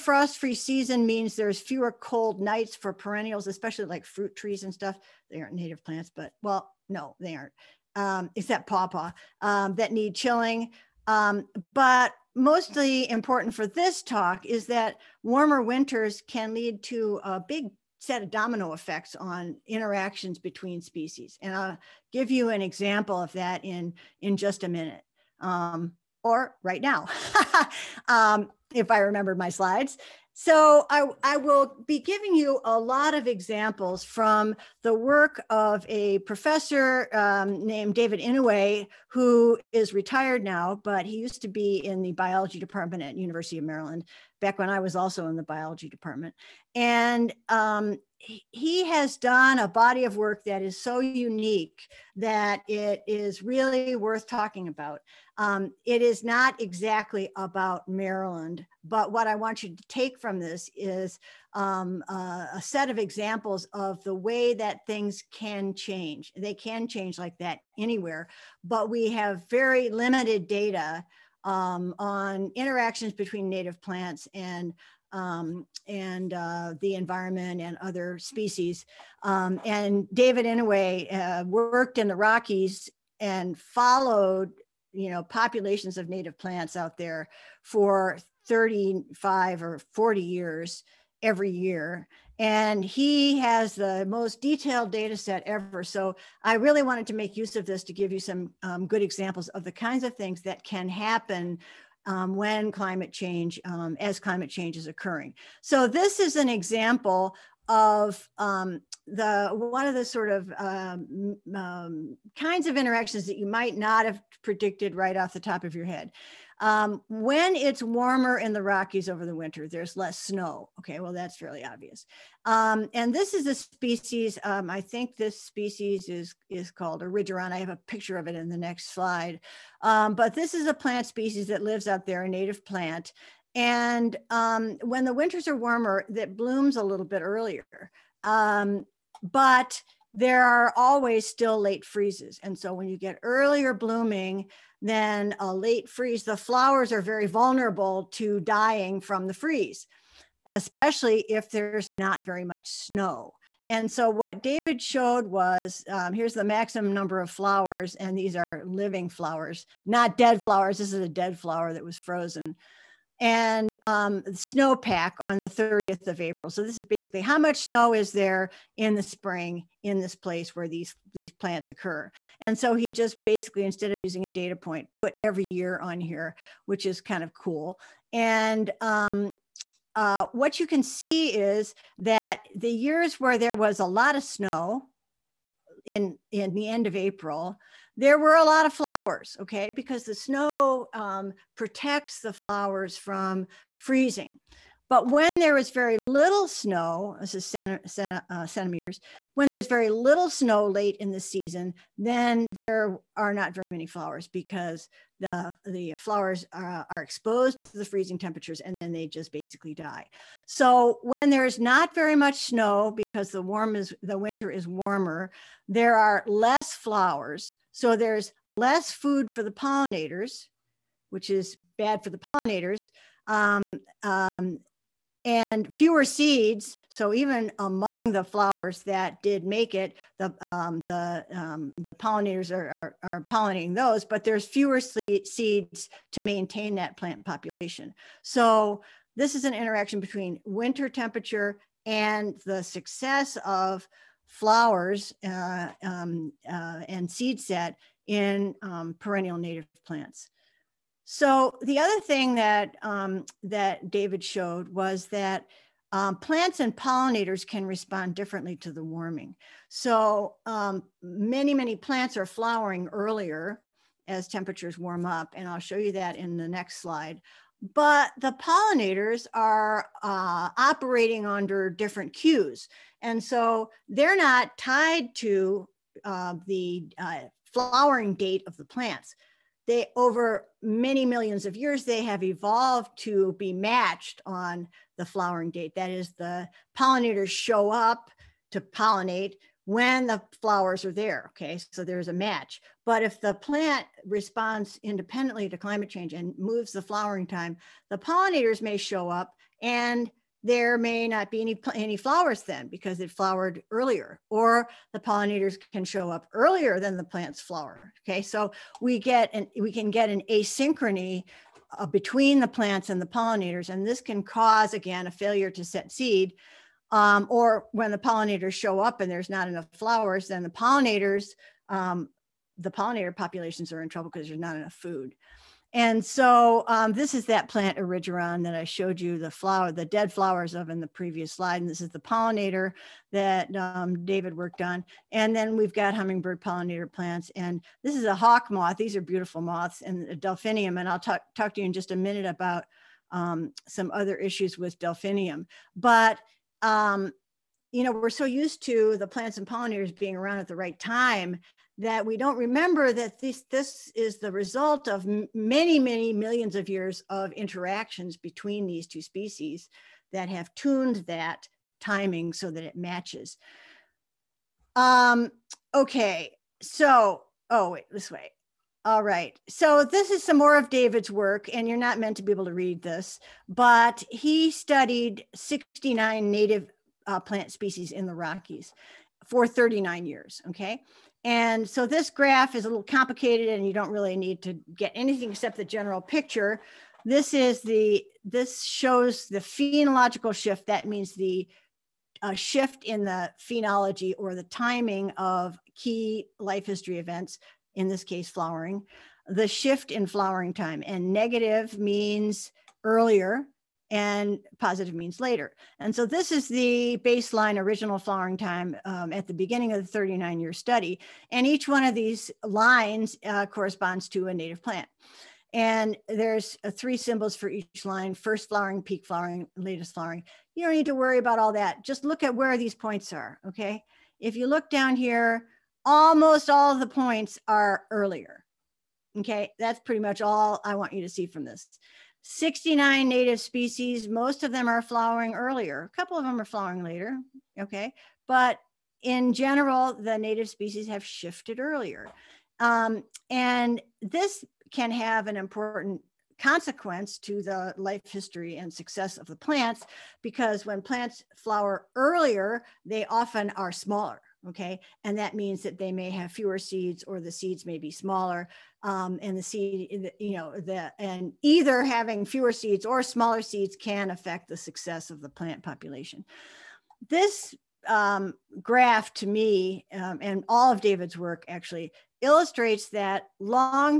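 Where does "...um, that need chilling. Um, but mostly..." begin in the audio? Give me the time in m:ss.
0:09.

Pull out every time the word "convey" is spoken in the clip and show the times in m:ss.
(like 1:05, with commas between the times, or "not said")
not said.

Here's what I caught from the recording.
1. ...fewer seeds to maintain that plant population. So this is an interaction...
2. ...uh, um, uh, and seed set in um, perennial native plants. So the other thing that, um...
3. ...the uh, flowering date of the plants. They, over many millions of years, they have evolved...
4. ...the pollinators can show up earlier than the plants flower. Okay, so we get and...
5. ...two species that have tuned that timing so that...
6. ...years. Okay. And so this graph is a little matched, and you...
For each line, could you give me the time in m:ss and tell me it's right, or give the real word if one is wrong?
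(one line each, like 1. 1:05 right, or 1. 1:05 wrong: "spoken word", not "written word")
1. 3:54 right
2. 4:05 right
3. 4:36 right
4. 5:04 right
5. 5:58 right
6. 6:20 wrong: "complicated", not "matched".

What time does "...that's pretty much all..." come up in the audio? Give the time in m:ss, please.
7:09.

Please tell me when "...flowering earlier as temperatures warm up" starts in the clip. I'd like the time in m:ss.
4:22.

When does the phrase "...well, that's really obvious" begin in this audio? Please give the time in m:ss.
2:01.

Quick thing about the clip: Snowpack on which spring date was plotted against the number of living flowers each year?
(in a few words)
30th of April.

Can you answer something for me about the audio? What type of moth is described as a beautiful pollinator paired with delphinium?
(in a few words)
hawk moth.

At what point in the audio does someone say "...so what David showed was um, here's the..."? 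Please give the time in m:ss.
2:33.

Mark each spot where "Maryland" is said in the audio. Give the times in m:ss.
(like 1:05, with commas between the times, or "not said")
0:43, 0:57.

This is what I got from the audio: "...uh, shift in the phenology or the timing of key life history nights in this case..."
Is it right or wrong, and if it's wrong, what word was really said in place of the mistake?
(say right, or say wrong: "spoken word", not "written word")
wrong: "events", not "nights".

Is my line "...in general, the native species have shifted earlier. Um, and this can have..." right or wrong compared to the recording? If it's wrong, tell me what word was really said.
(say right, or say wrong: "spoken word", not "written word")
right.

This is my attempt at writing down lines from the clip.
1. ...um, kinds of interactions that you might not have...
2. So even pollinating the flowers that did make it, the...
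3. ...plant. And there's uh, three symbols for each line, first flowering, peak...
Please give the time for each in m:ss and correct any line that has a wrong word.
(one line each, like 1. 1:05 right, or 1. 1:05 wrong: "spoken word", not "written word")
1. 1:51 right
2. 3:46 wrong: "among", not "pollinating"
3. 6:54 right.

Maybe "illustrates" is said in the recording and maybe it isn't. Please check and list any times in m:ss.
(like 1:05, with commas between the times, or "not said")
7:52.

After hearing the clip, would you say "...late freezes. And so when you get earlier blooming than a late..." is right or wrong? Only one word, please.
right.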